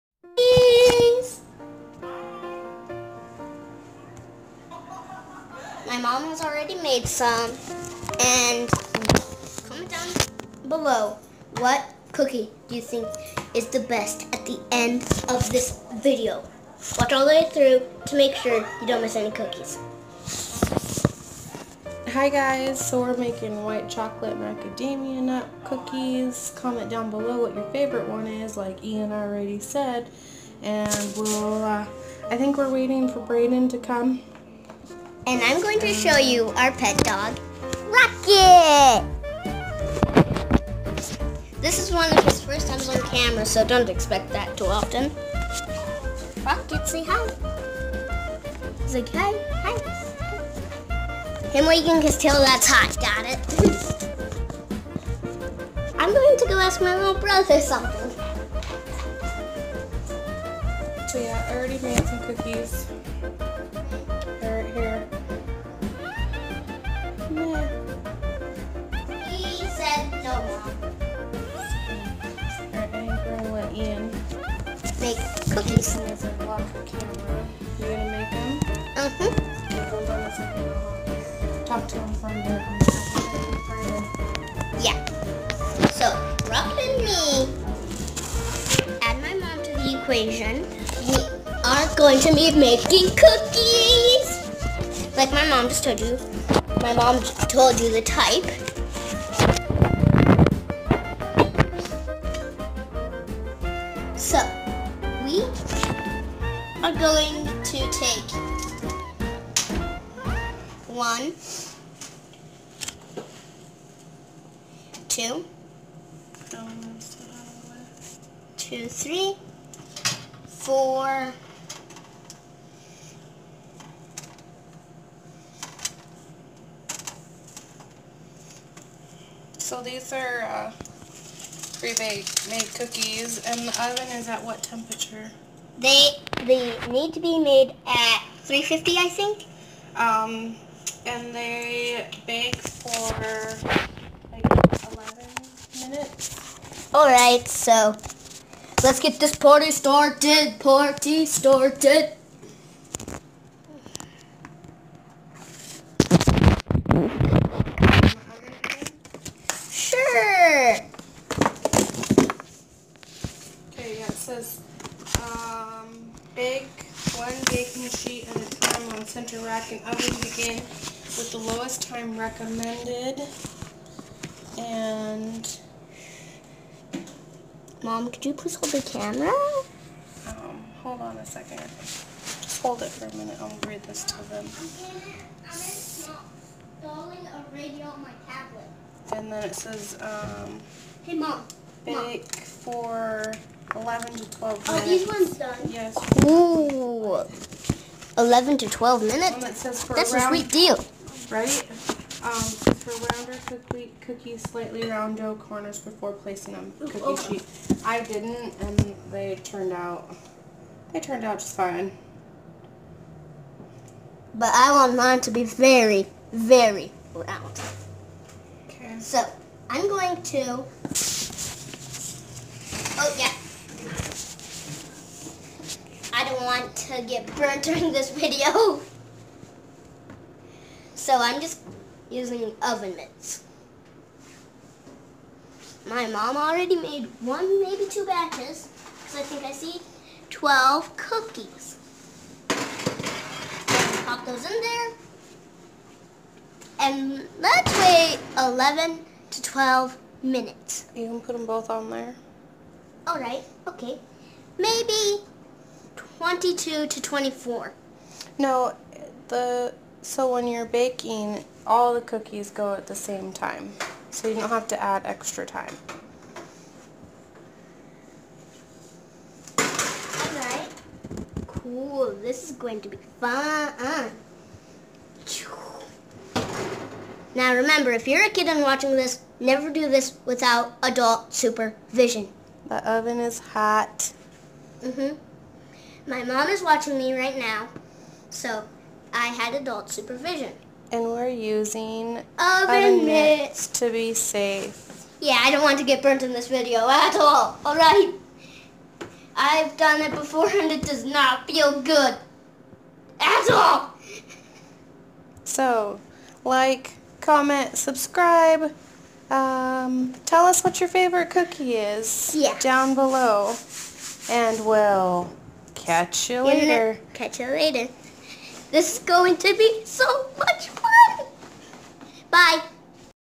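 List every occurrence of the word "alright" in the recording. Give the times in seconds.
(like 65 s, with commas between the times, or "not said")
253 s, 269 s, 297 s.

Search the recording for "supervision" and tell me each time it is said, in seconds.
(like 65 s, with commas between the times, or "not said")
281 s, 289 s.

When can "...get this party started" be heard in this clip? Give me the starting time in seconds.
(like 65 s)
148 s.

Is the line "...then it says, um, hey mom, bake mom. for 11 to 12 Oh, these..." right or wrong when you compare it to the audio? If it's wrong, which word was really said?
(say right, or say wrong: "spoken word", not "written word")
right.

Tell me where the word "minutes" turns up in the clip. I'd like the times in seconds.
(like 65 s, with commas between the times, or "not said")
145 s, 183 s, 199 s, 250 s.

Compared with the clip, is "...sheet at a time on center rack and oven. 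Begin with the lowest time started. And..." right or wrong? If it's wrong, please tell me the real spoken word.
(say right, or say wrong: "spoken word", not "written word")
wrong: "recommended", not "started".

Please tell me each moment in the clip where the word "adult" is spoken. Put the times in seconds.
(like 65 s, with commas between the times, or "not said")
280 s, 289 s.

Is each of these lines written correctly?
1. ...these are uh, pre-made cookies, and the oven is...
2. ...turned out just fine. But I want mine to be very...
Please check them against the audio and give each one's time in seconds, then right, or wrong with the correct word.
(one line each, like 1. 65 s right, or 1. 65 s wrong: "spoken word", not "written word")
1. 129 s right
2. 210 s right.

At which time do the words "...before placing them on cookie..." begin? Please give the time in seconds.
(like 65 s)
205 s.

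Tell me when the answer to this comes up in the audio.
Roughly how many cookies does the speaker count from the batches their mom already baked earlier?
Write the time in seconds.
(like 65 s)
240 s.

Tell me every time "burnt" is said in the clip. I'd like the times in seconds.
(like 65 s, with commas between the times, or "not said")
227 s, 296 s.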